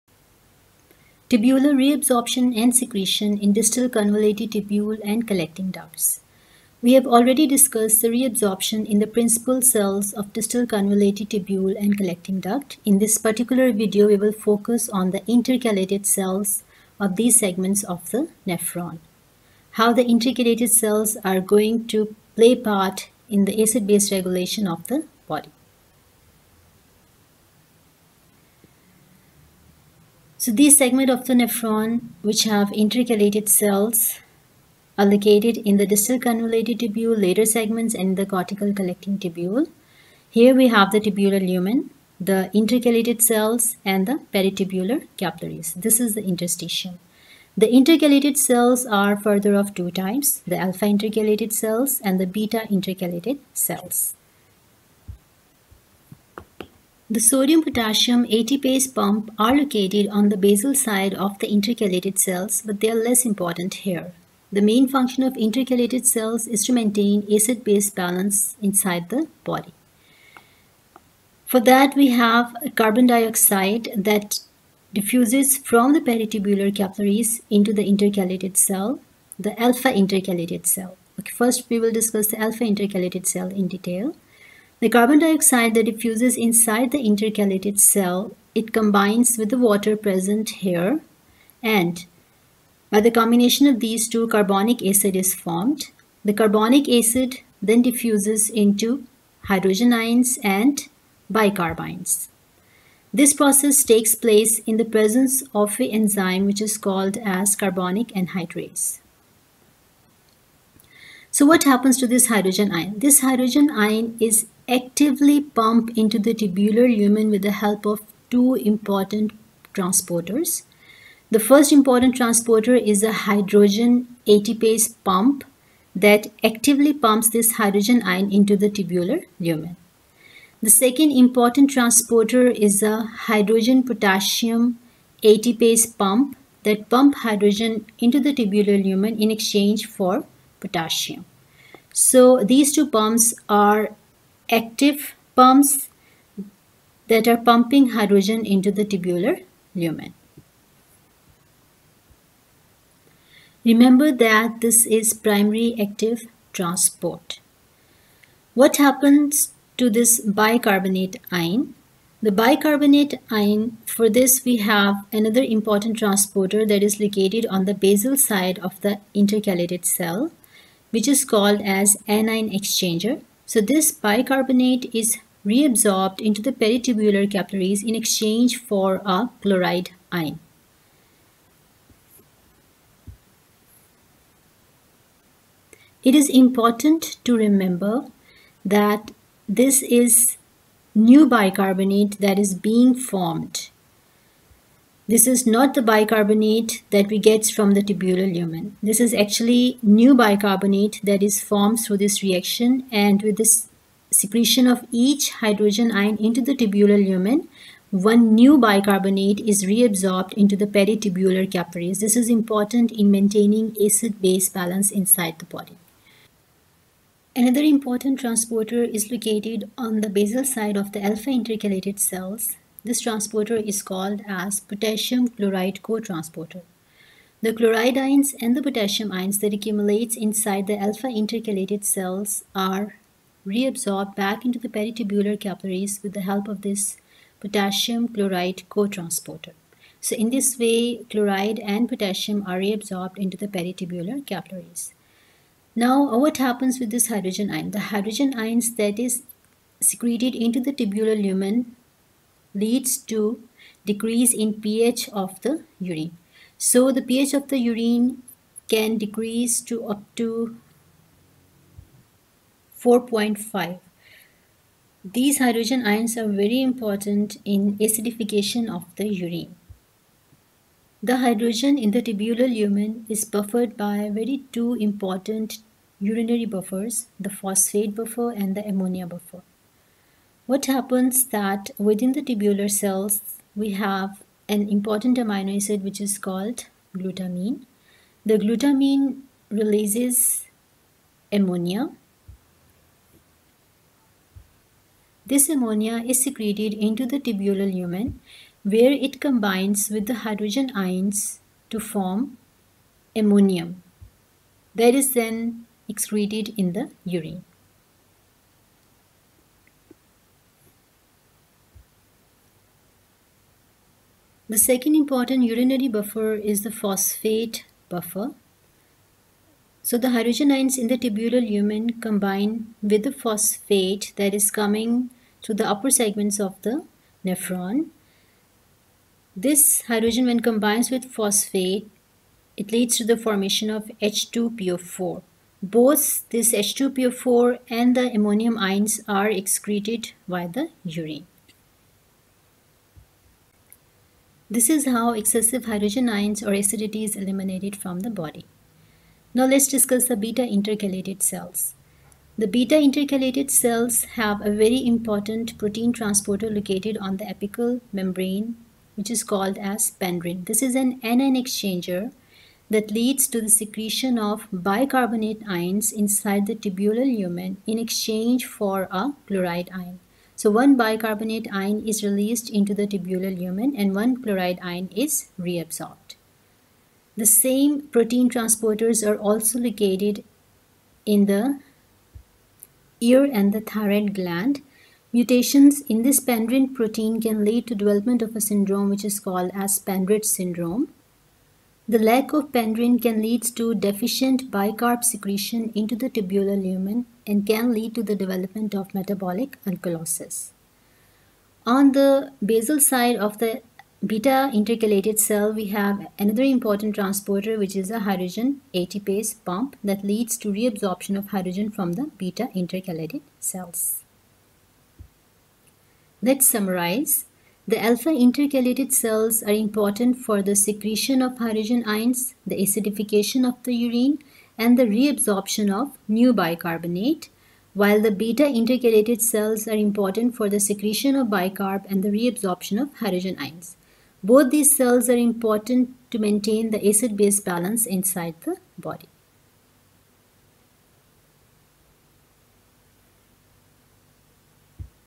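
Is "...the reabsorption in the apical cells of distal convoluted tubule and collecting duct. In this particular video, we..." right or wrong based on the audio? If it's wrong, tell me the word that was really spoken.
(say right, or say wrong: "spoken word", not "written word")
wrong: "principal", not "apical".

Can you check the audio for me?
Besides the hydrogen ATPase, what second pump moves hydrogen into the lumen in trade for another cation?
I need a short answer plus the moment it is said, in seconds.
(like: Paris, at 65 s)
hydrogen potassium ATPase, at 133 s.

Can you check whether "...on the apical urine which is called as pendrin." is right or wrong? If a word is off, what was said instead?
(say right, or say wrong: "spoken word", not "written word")
wrong: "membrane", not "urine".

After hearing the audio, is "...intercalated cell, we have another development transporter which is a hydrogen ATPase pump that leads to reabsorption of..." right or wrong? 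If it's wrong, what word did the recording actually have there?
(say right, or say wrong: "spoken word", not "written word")
wrong: "important", not "development".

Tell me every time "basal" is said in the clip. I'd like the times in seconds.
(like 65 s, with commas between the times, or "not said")
60 s, 167 s, 220 s, 402 s.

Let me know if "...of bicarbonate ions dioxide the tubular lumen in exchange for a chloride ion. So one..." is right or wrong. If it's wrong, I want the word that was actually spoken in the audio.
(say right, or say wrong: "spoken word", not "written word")
wrong: "inside", not "dioxide".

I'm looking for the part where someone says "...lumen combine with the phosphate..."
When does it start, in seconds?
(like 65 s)
321 s.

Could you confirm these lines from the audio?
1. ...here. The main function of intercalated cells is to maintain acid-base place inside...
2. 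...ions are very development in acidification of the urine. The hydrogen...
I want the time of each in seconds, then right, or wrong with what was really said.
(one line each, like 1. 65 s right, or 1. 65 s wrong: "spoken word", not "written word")
1. 63 s wrong: "balance", not "place"
2. 265 s wrong: "important", not "development".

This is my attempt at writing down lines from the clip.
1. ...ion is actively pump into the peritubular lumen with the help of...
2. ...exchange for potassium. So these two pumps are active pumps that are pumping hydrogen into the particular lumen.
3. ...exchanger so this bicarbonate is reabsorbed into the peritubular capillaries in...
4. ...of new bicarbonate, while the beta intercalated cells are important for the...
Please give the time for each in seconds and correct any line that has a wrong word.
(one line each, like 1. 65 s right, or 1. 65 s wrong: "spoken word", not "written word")
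1. 113 s wrong: "tubular", not "peritubular"
2. 139 s wrong: "tubular", not "particular"
3. 172 s right
4. 425 s right.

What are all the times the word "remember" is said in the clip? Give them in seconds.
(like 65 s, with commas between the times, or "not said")
153 s, 187 s.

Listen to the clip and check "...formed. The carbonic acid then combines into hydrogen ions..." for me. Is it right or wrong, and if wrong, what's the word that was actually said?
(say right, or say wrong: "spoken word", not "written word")
wrong: "diffuses", not "combines".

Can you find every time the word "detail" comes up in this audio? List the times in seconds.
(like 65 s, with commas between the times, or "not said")
83 s.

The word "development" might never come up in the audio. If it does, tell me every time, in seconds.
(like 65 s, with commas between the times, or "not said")
387 s, 398 s.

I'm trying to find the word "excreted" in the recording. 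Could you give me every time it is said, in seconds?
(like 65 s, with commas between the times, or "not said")
305 s, 339 s.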